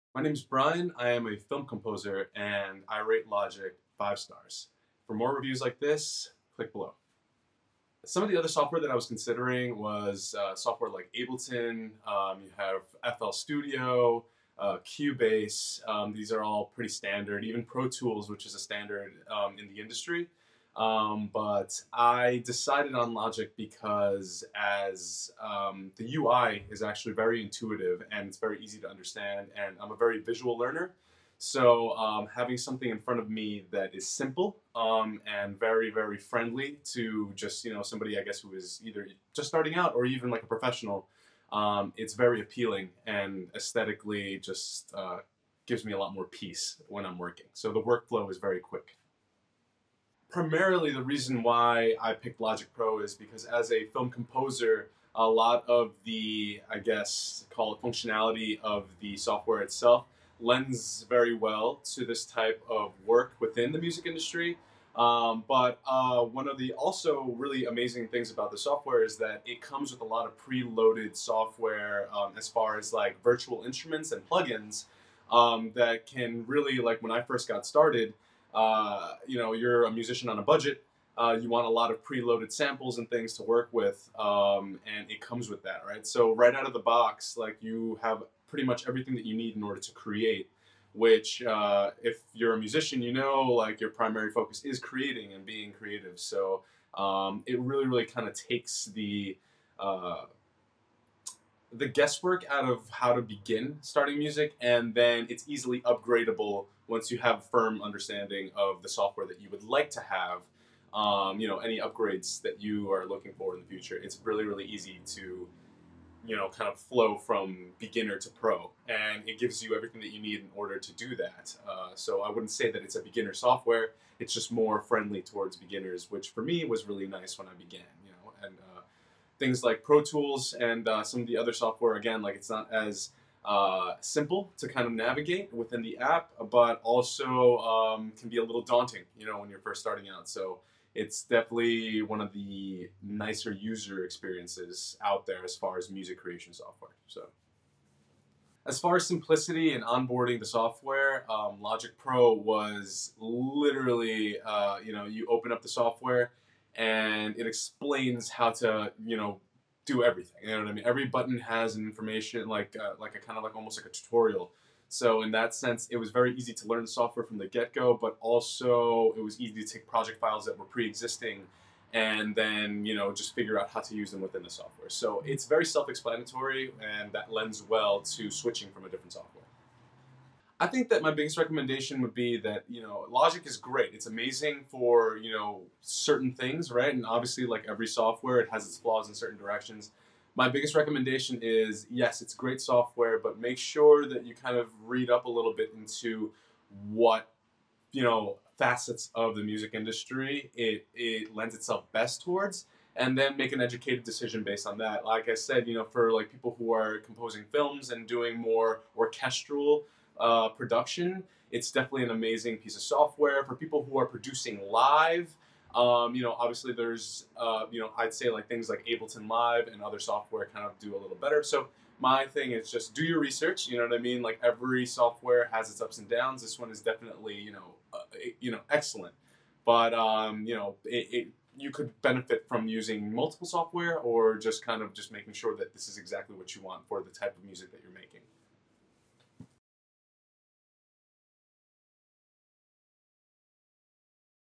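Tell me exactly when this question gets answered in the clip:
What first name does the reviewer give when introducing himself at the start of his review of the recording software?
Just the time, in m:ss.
0:00.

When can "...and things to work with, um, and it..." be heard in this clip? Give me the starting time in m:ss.
1:22.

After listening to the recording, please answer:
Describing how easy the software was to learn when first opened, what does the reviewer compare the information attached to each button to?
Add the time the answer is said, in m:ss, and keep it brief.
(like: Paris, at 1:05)
A tutorial, at 2:43.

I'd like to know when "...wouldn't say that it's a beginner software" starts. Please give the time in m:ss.
2:02.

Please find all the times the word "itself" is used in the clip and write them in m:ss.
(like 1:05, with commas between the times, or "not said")
0:59, 3:21.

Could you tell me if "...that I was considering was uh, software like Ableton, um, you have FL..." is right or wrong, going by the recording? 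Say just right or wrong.
right.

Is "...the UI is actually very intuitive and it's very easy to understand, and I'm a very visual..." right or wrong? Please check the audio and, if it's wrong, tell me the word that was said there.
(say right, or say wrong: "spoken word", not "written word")
right.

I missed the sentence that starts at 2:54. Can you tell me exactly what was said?
So it's very self explanatory, and that lends well to switching from a different software.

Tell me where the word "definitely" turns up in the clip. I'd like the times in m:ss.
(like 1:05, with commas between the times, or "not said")
2:21, 3:31, 3:46.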